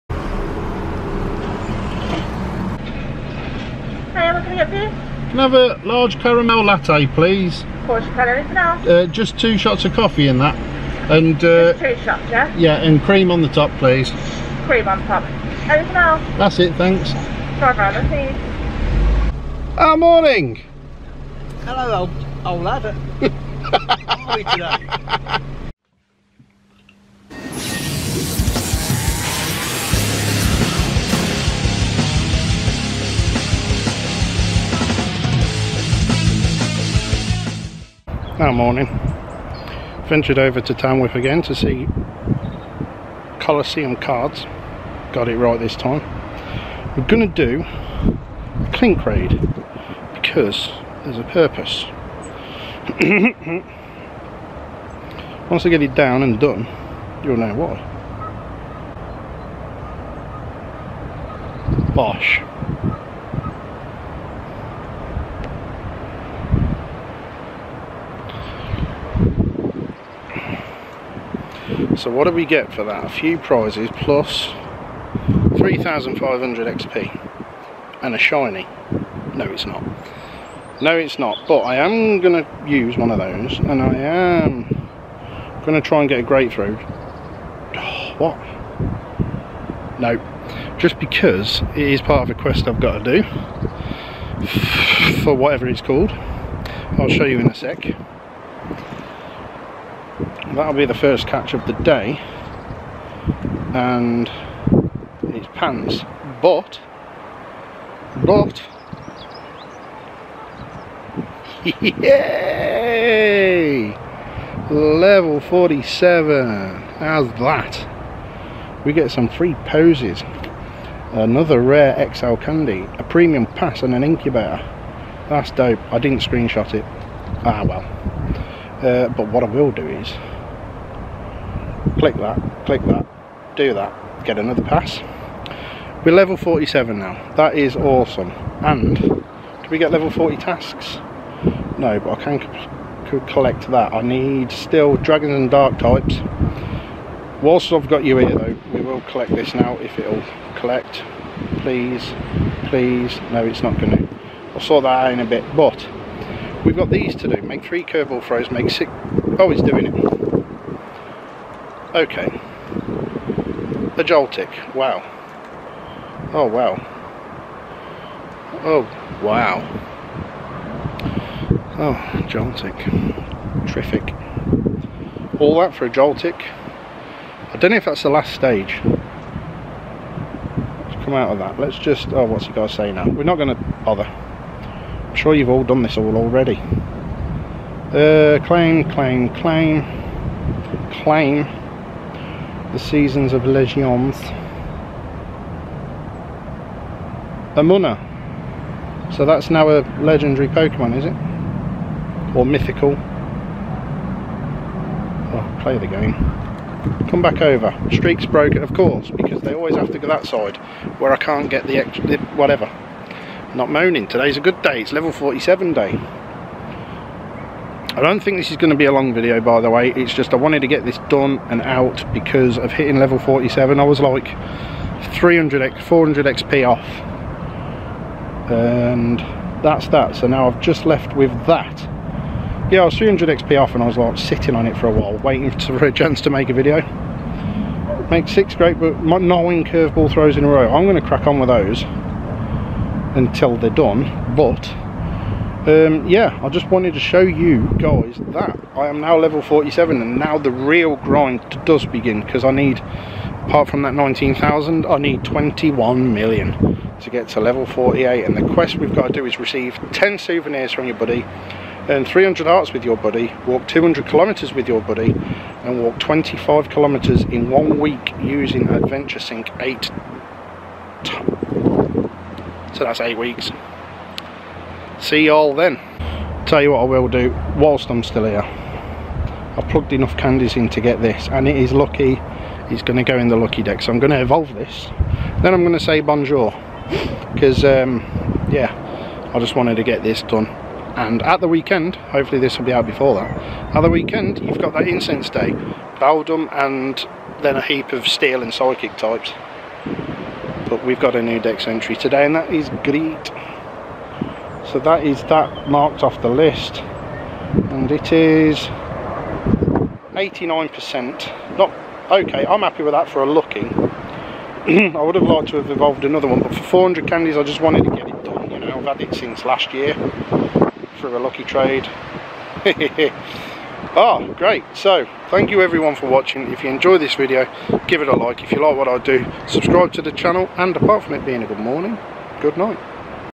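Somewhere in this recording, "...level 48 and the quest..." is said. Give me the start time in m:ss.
4:17.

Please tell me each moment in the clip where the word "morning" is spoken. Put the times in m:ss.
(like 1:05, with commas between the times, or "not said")
0:19, 0:38, 5:31.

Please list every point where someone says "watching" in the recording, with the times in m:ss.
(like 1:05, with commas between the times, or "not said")
5:26.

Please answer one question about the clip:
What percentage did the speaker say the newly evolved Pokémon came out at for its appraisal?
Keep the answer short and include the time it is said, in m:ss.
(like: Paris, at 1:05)
89%, at 5:10.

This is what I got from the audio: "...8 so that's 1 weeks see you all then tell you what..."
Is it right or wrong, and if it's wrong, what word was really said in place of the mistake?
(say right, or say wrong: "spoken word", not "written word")
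wrong: "8", not "1".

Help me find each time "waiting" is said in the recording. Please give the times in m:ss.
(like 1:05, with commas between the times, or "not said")
3:55.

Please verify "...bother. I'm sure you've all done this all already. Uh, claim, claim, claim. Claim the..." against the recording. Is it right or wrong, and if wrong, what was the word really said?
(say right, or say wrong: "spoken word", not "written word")
right.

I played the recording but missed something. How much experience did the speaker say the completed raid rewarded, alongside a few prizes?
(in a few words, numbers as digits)
3,500 XP.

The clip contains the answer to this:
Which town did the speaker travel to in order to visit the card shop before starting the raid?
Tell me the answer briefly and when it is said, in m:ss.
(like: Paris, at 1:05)
Tamworth, at 0:40.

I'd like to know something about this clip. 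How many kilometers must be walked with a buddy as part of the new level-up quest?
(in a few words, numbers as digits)
200 kilometers.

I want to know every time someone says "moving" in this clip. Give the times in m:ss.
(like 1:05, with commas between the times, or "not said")
not said.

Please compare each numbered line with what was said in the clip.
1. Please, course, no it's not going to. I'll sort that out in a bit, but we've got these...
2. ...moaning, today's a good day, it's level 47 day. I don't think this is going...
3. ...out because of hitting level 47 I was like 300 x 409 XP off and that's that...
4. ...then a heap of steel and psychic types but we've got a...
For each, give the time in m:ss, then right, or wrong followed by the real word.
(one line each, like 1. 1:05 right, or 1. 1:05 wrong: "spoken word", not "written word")
1. 2:31 wrong: "please", not "course"
2. 3:33 right
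3. 3:41 wrong: "400", not "409"
4. 4:57 right.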